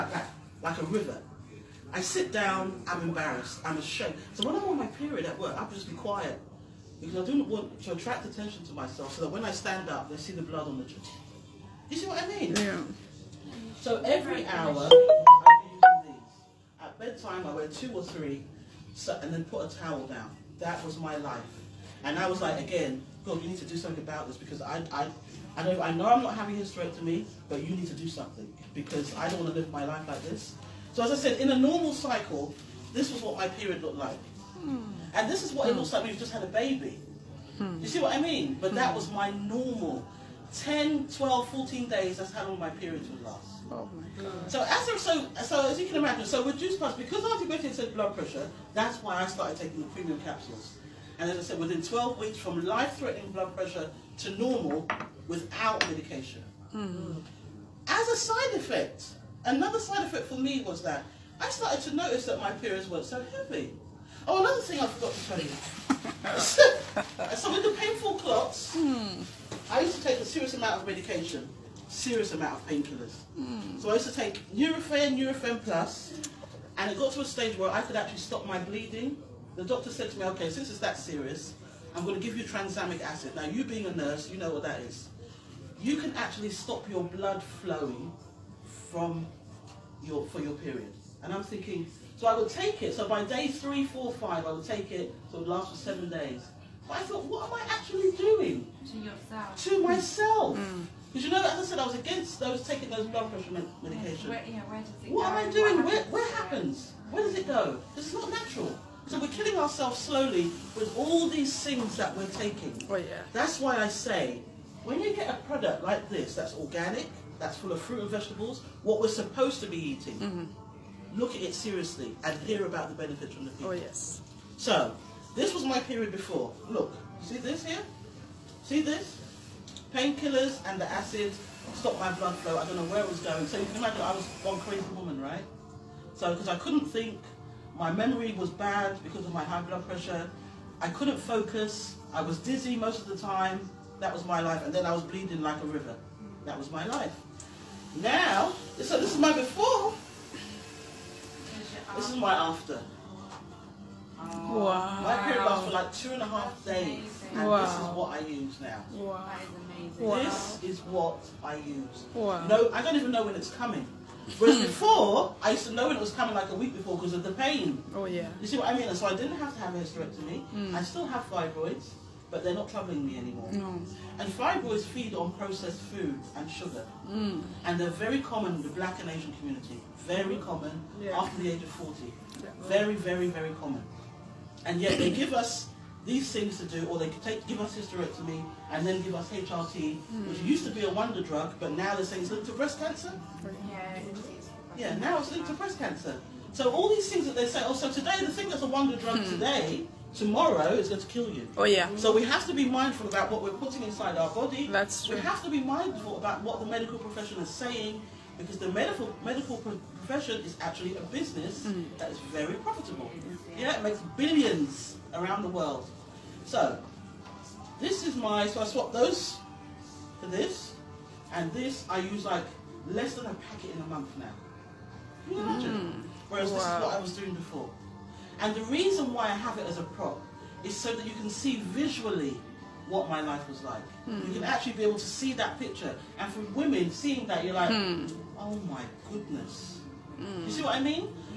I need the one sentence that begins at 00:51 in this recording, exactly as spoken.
And as I said, within 12 weeks from life-threatening blood pressure to normal without medication.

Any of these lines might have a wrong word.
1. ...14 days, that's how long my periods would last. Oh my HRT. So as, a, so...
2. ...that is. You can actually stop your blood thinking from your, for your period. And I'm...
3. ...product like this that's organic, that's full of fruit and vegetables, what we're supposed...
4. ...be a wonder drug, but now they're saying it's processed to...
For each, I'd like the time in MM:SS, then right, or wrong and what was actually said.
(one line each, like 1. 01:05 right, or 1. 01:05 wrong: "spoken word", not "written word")
1. 00:41 wrong: "God", not "HRT"
2. 01:24 wrong: "flowing", not "thinking"
3. 01:55 right
4. 03:10 wrong: "linked", not "processed".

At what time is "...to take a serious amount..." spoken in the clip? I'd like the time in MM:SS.
01:09.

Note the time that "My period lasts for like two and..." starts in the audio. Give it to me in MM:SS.
02:35.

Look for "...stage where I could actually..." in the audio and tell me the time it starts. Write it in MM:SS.
01:17.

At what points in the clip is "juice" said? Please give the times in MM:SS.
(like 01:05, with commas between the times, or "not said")
00:46.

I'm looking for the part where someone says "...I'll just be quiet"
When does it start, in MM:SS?
00:05.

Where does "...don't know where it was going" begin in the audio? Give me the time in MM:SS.
02:12.